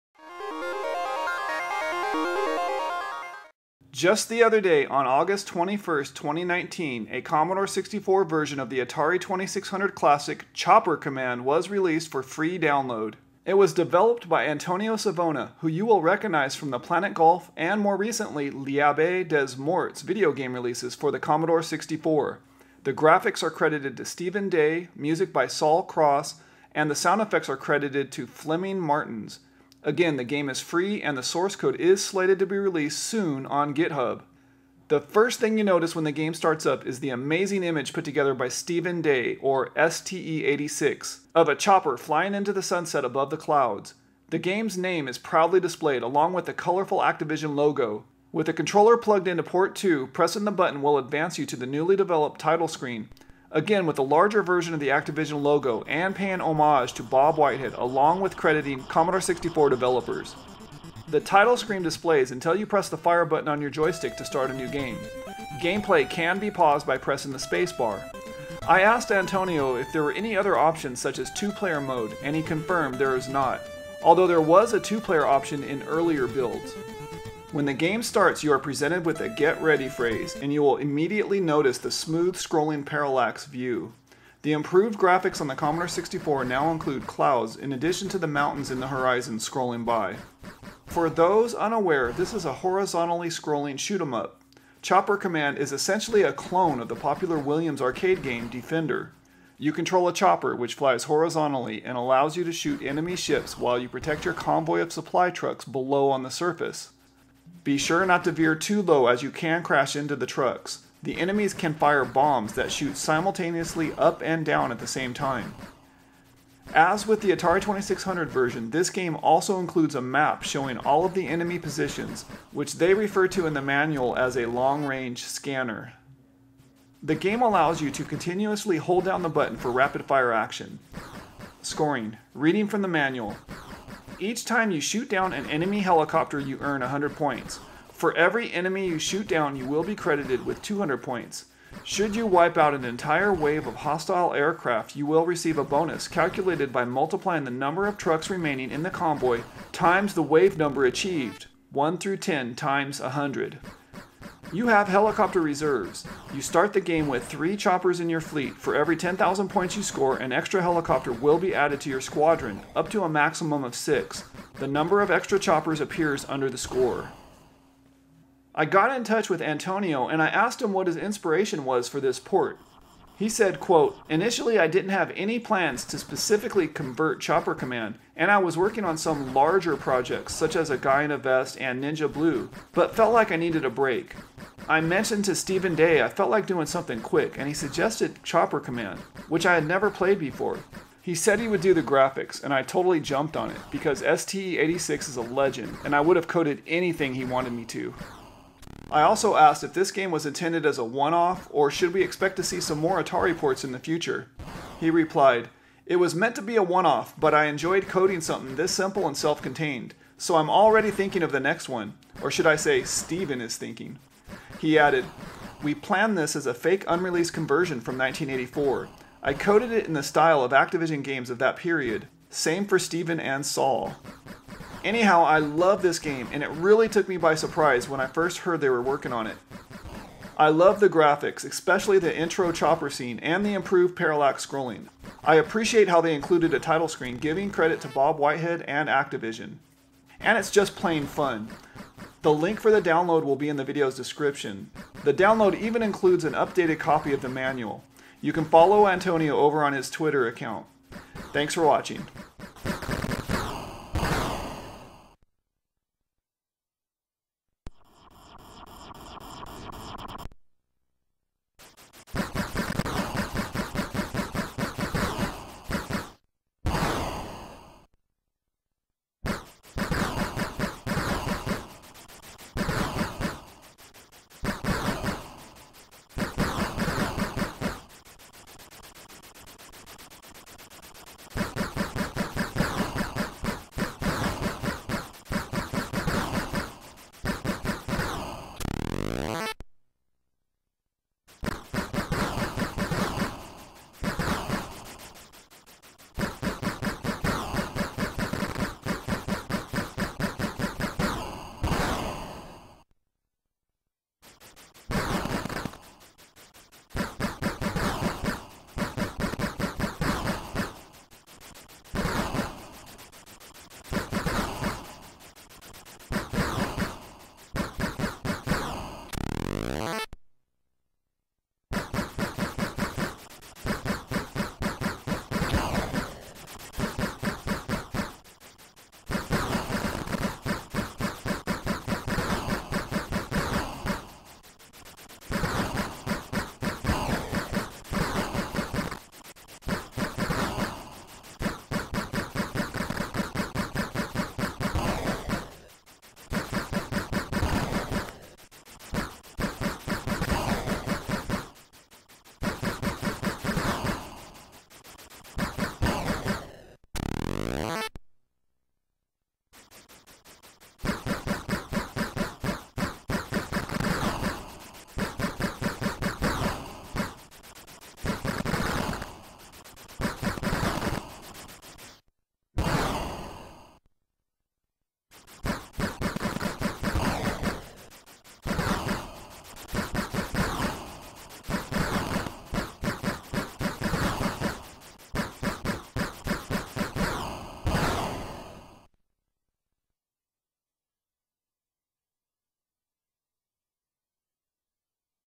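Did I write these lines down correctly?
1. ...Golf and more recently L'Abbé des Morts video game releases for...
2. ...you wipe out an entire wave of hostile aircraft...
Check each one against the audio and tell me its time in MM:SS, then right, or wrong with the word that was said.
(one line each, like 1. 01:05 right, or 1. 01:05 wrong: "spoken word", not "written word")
1. 00:17 right
2. 02:22 right.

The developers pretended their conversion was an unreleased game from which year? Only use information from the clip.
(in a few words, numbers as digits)
1984.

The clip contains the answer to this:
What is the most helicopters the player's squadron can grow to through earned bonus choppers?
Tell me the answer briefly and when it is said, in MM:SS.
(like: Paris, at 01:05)
6, at 02:43.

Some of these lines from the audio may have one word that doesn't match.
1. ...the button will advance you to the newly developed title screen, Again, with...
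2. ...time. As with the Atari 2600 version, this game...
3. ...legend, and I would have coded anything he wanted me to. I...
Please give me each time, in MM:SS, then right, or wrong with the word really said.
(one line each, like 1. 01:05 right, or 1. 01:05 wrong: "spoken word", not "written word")
1. 00:50 right
2. 01:55 right
3. 03:15 right.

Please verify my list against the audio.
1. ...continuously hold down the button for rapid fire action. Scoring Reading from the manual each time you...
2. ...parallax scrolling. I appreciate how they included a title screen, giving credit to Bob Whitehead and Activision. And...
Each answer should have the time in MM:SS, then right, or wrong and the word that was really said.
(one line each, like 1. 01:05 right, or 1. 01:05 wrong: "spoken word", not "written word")
1. 02:08 right
2. 03:53 right.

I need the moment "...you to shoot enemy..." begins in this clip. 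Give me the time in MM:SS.
01:42.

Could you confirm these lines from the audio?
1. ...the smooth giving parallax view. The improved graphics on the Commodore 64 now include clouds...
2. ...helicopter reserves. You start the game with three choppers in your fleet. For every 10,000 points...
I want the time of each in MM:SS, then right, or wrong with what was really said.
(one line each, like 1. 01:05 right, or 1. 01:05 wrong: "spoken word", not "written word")
1. 01:21 wrong: "scrolling", not "giving"
2. 02:34 right.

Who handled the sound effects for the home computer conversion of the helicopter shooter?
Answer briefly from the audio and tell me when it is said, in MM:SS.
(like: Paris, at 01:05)
Flemming Martins, at 00:28.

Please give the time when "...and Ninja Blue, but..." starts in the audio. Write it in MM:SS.
03:01.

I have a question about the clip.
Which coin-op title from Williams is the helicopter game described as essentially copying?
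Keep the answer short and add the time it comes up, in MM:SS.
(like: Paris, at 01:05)
Defender, at 01:38.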